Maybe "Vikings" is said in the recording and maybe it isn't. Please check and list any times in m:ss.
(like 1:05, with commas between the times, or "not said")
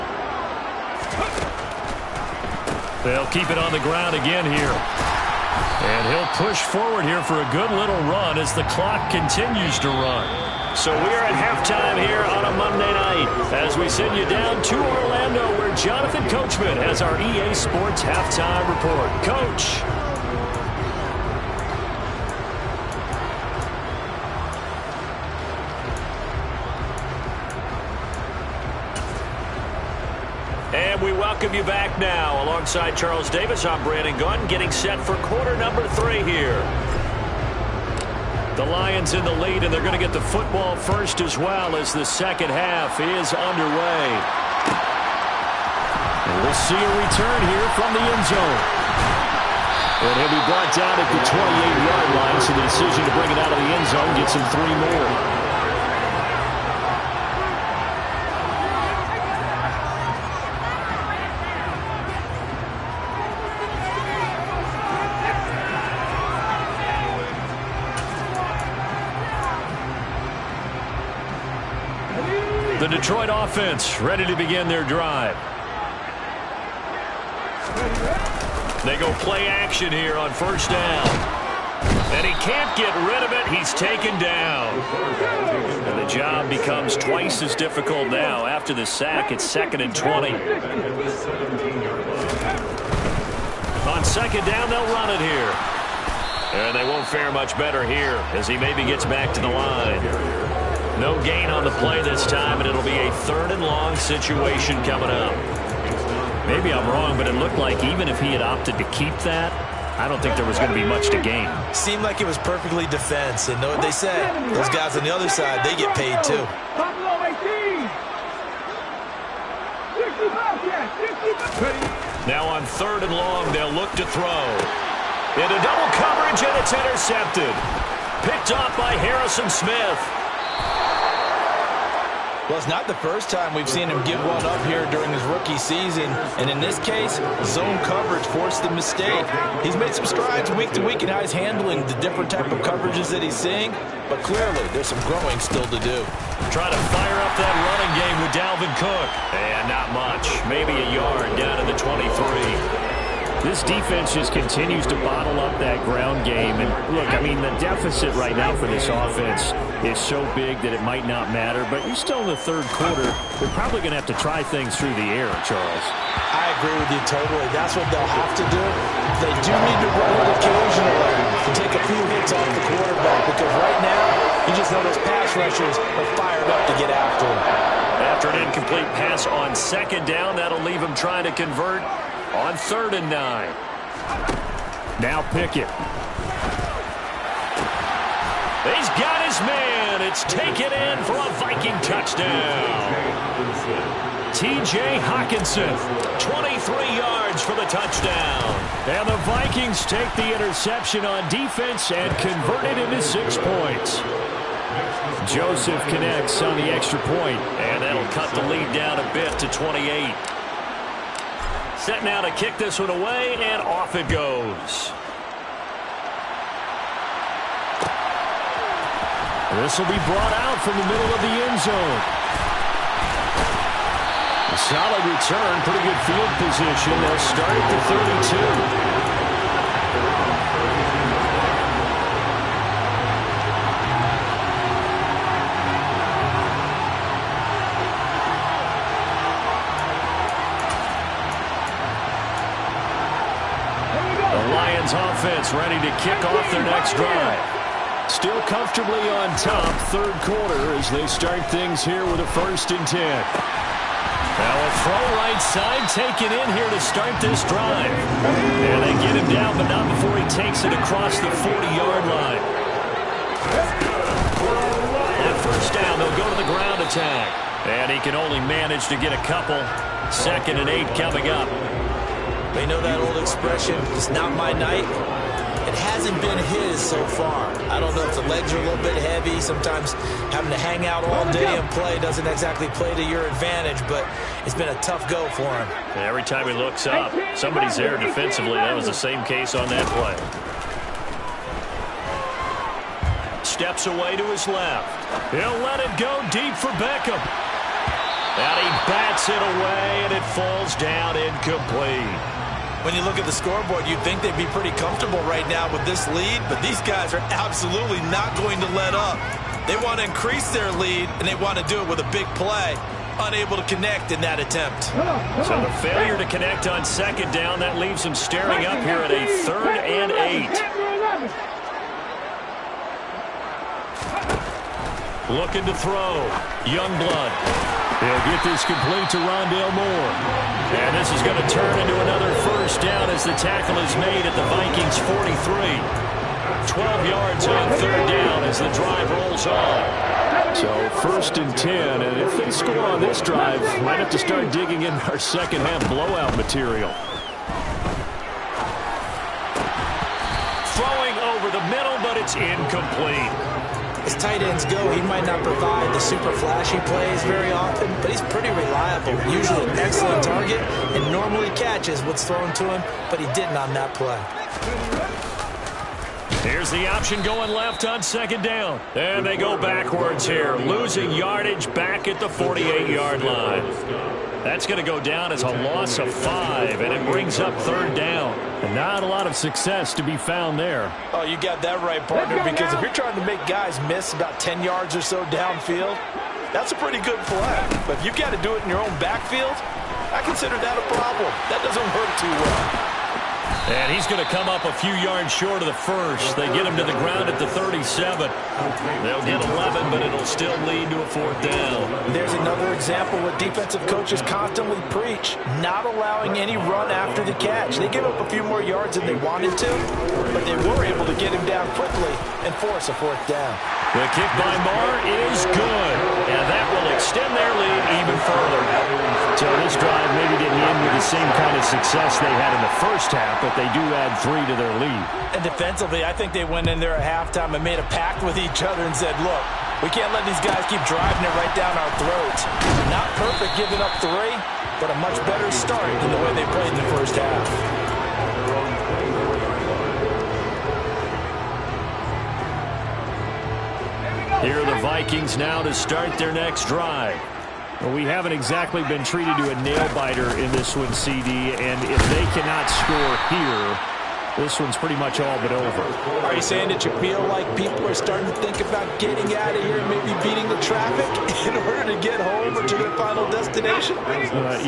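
3:11, 3:19, 5:34, 7:24.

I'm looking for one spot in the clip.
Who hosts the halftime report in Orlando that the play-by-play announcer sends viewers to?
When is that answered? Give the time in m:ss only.
0:15.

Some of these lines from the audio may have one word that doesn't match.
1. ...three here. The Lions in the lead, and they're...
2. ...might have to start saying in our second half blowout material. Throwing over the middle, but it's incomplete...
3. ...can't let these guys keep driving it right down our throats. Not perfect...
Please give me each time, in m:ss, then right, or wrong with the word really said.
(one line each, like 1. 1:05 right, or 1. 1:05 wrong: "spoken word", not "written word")
1. 0:35 right
2. 5:43 wrong: "digging", not "saying"
3. 7:09 right.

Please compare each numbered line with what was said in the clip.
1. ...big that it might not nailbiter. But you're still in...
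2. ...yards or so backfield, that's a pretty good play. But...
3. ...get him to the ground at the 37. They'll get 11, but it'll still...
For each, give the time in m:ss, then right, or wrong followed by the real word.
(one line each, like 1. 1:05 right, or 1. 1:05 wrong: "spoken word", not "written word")
1. 2:40 wrong: "matter", not "nailbiter"
2. 6:24 wrong: "downfield", not "backfield"
3. 6:36 right.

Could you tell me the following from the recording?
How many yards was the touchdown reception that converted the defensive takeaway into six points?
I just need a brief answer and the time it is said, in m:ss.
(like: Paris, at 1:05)
23, at 3:16.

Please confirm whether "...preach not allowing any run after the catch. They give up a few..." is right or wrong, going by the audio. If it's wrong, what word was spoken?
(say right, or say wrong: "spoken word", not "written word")
right.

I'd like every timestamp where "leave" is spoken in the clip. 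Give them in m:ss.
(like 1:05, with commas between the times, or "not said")
3:00, 5:17.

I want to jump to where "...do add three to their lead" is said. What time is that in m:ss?
7:03.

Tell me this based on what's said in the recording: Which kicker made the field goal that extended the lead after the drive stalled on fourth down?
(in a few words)
Maher.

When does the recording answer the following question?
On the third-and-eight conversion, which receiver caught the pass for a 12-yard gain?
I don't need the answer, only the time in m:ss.
5:29.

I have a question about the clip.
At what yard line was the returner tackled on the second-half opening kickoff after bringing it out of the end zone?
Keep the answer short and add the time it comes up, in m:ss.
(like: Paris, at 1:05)
28, at 0:51.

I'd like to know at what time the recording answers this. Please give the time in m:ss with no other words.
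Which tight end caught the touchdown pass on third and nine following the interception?
3:14.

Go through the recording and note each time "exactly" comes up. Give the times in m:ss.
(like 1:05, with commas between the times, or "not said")
4:42, 7:28.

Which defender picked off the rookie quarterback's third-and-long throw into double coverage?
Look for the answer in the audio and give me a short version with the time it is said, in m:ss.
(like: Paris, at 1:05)
Harrison Smith, at 2:08.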